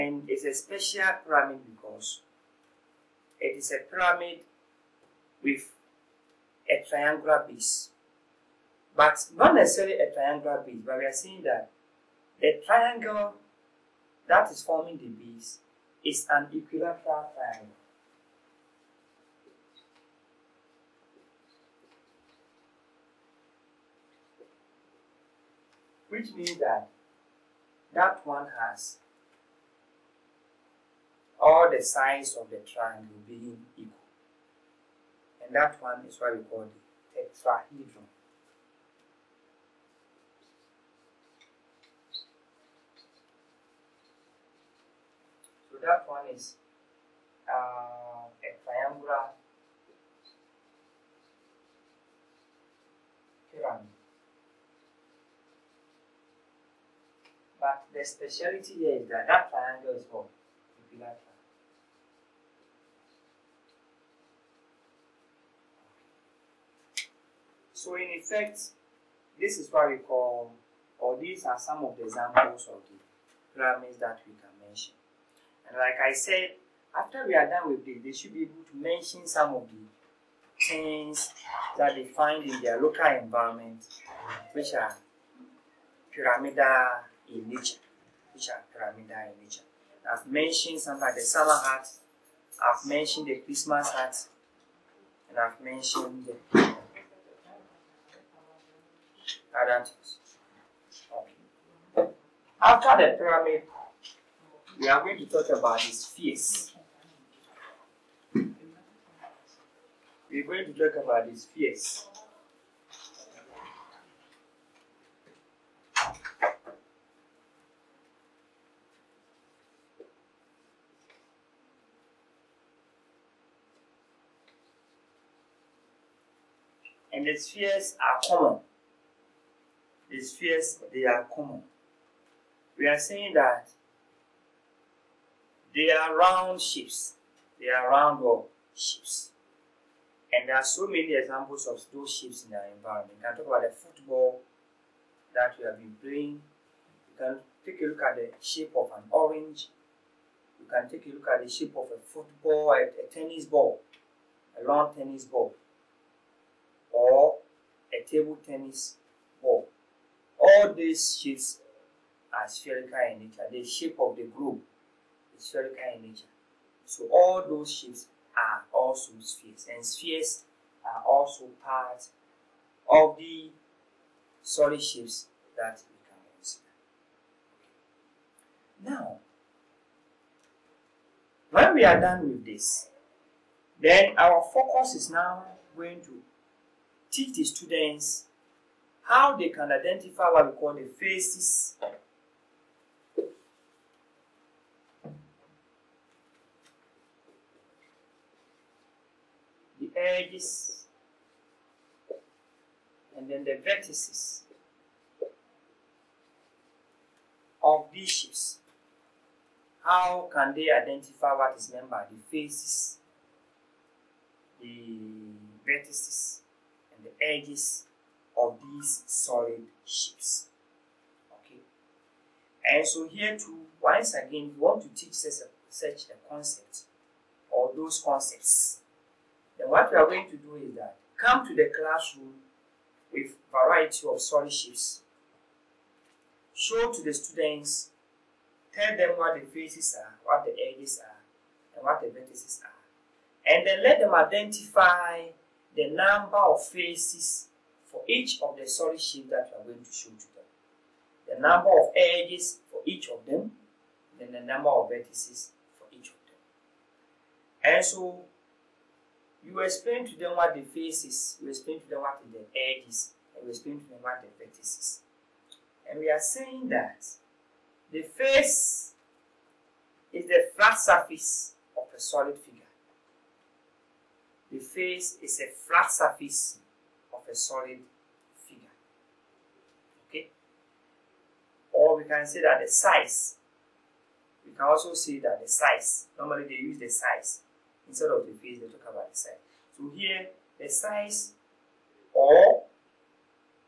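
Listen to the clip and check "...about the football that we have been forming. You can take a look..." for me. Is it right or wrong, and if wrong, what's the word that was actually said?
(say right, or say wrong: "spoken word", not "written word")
wrong: "playing", not "forming".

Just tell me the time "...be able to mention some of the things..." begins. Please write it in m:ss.
1:18.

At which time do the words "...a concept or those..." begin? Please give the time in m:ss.
3:46.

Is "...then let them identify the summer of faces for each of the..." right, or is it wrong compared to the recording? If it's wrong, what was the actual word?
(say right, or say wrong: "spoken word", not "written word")
wrong: "number", not "summer".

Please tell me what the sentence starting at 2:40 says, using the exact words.
All these shapes are spherical in nature.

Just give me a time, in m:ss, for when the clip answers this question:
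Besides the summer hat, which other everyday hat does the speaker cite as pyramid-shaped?
1:33.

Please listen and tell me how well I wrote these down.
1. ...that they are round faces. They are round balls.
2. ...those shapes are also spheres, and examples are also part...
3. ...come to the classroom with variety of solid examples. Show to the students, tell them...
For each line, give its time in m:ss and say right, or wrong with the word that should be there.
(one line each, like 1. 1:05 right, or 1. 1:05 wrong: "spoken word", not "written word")
1. 2:13 wrong: "shapes", not "faces"
2. 2:47 wrong: "spheres", not "examples"
3. 3:51 wrong: "shapes", not "examples".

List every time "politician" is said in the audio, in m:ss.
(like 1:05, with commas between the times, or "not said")
not said.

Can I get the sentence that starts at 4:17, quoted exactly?
And so you explain to them what the faces.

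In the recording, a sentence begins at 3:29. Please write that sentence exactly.
How can they identify what is meant by the faces, the vertices, edges of these solid shapes.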